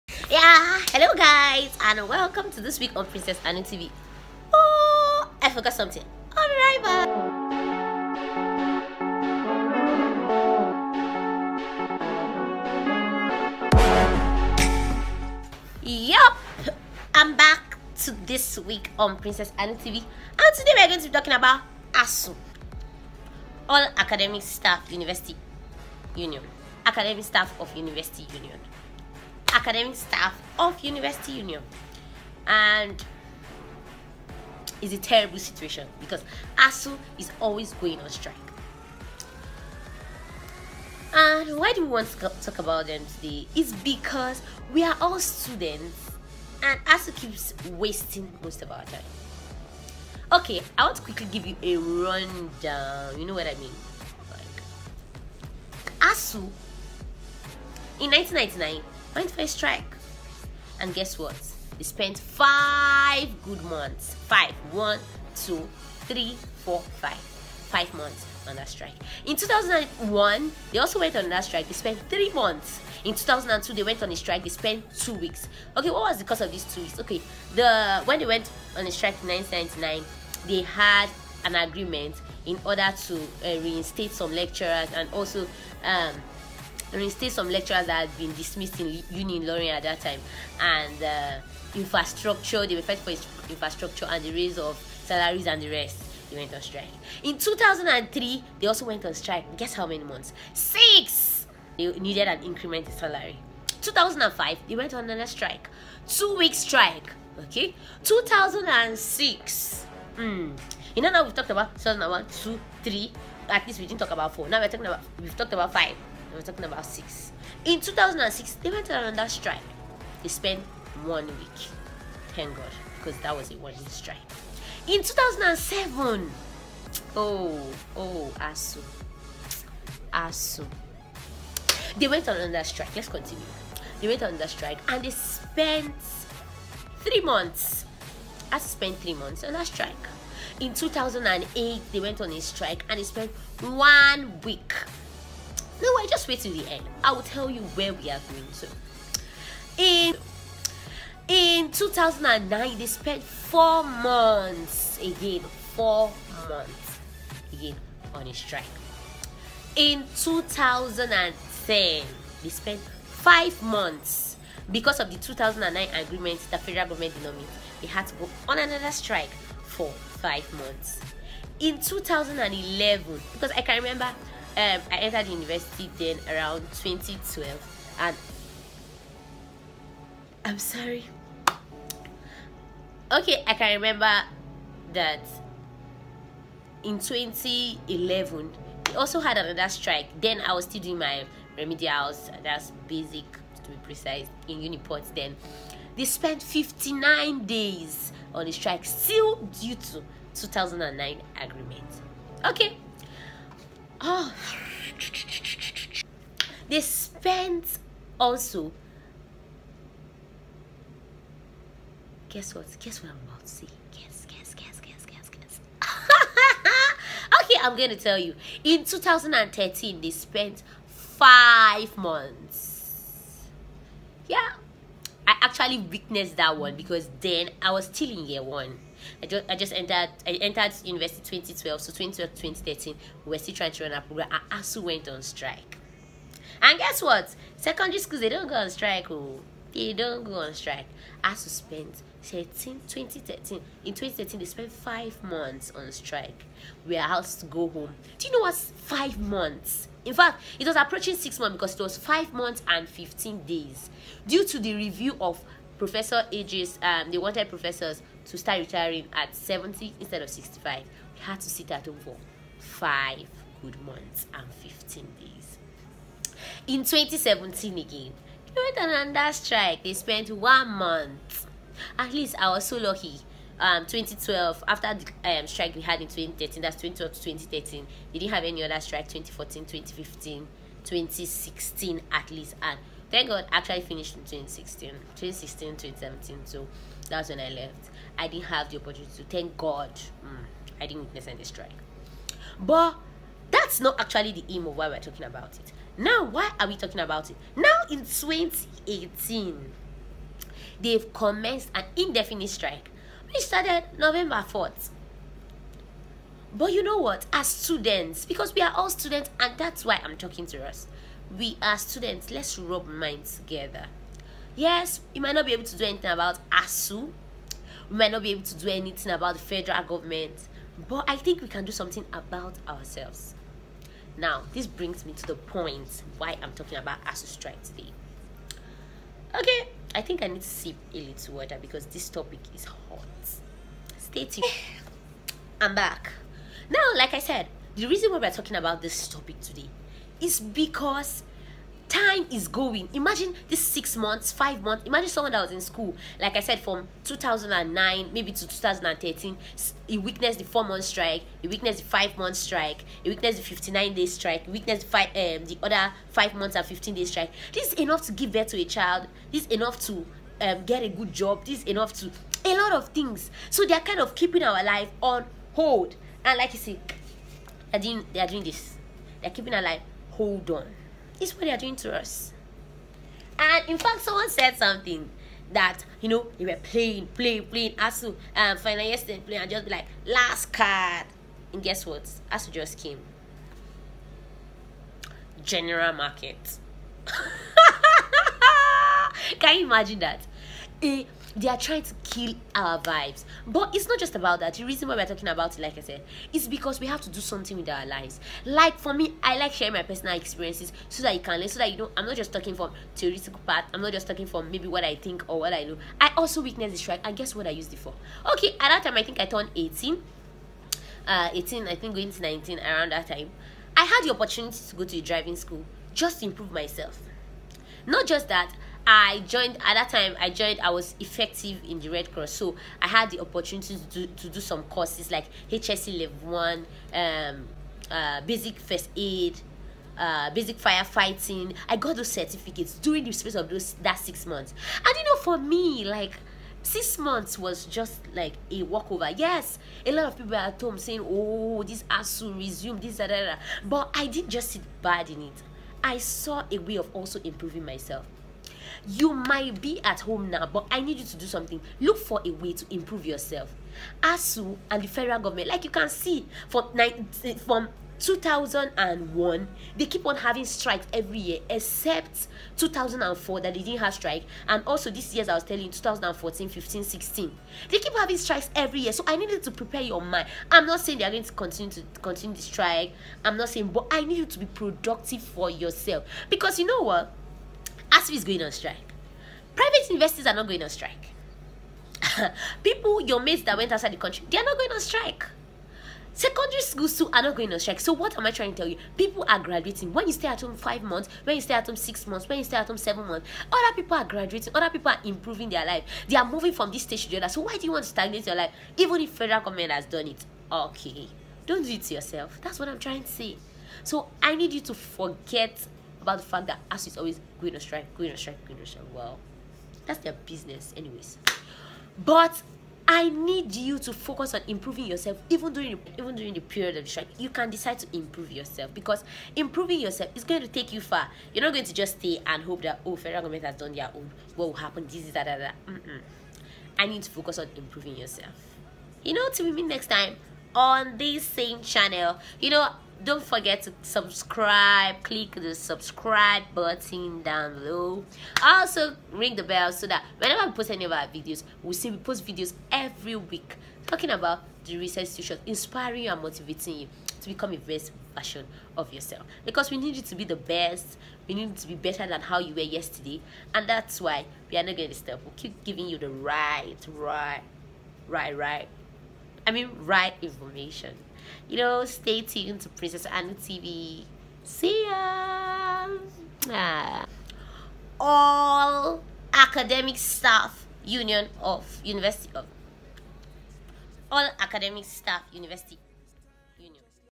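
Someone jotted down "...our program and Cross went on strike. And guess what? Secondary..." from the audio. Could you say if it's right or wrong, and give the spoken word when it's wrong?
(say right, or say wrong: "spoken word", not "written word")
wrong: "ASU", not "Cross".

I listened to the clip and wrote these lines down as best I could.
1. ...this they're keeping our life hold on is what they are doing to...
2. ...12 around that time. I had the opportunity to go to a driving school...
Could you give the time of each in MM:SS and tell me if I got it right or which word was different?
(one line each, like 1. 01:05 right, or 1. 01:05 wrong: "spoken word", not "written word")
1. 06:08 right
2. 06:52 wrong: "19", not "12".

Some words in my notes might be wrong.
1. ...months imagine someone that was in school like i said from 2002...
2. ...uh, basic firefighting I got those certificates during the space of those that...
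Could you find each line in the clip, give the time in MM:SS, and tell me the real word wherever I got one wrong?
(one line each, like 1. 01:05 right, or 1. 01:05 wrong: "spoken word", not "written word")
1. 05:44 wrong: "2009", not "2002"
2. 07:09 right.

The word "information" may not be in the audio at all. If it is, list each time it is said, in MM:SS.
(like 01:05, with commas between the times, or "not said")
09:20.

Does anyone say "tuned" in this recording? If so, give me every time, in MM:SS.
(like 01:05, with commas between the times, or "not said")
05:34, 09:22.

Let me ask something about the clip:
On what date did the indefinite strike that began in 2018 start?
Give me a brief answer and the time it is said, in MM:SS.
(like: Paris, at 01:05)
November 4th, at 05:03.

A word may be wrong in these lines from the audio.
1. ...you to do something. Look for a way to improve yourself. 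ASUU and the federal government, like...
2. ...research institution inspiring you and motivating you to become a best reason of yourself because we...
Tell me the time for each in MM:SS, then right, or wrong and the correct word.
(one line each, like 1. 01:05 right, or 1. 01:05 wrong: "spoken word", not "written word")
1. 07:30 right
2. 09:04 wrong: "version", not "reason".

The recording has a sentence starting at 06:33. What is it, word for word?
But it's not just about that.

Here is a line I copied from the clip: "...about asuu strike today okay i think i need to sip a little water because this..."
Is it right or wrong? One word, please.
right.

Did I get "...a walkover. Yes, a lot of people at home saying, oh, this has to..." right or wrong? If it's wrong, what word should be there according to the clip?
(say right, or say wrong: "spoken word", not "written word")
right.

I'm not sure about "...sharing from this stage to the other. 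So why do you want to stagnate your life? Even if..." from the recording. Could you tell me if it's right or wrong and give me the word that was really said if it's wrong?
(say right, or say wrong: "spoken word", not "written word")
wrong: "moving", not "sharing".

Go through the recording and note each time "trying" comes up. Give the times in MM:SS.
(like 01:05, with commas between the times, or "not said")
03:53, 06:31, 08:08, 08:22.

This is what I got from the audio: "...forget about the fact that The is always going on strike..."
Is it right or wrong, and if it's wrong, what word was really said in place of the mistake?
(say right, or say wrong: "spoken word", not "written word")
wrong: "ASUU", not "The".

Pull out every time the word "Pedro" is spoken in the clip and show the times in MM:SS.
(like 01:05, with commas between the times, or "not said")
not said.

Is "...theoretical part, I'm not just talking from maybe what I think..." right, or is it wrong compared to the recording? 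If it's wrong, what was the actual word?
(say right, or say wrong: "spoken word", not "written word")
right.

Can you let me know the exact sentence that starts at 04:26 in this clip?
In 2017 again, they went on another strike.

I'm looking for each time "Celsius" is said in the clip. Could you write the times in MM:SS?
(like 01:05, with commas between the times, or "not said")
not said.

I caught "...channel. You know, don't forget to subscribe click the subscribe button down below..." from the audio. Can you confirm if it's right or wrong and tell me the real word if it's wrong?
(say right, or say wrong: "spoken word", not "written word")
right.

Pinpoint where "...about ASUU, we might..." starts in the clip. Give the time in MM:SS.
05:16.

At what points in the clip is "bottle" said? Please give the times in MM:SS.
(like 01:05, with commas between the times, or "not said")
not said.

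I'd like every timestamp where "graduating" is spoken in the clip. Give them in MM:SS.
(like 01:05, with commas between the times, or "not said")
08:09, 08:14.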